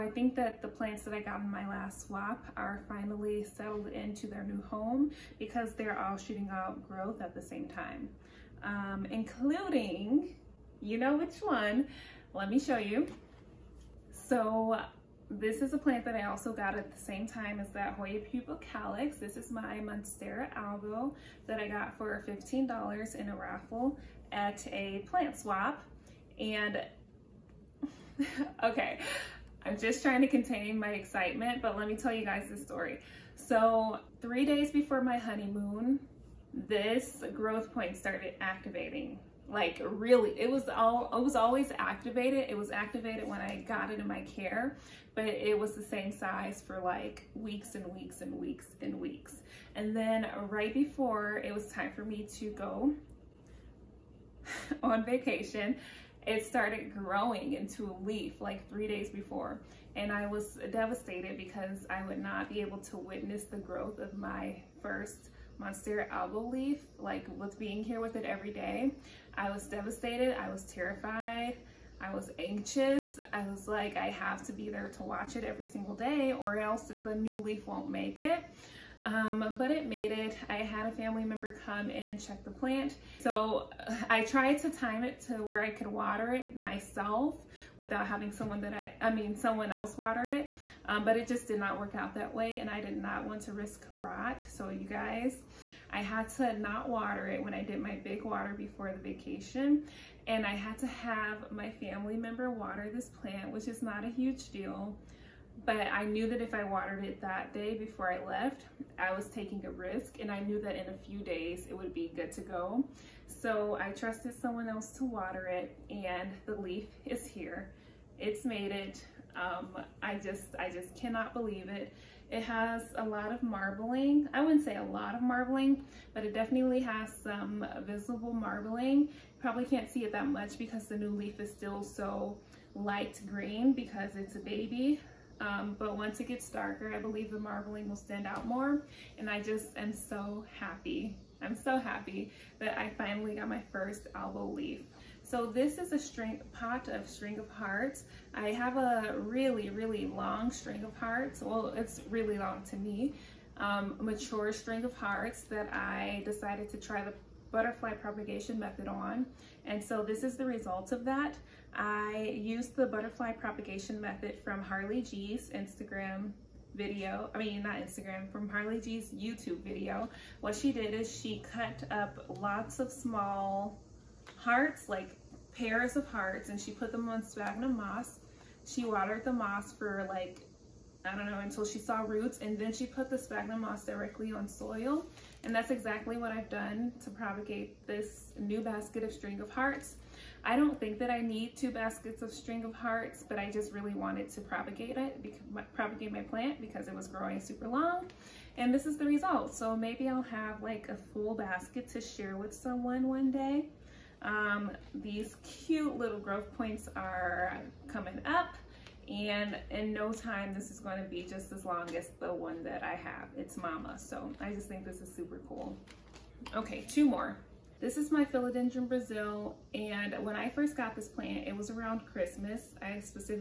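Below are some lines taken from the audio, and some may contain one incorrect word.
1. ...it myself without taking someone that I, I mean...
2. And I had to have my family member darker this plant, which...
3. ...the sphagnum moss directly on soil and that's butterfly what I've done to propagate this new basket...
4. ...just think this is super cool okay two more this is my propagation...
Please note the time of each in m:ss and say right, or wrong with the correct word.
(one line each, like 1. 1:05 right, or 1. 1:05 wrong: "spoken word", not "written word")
1. 1:26 wrong: "having", not "taking"
2. 1:40 wrong: "water", not "darker"
3. 3:03 wrong: "exactly", not "butterfly"
4. 3:34 wrong: "philodendron", not "propagation".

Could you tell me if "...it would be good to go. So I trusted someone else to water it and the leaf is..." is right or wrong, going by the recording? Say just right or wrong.
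right.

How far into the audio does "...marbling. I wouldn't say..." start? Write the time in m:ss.
2:03.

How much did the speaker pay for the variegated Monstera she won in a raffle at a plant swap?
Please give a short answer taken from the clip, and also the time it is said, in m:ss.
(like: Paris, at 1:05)
$15, at 0:22.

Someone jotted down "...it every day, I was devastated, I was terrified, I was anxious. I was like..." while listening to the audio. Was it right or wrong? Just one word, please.
right.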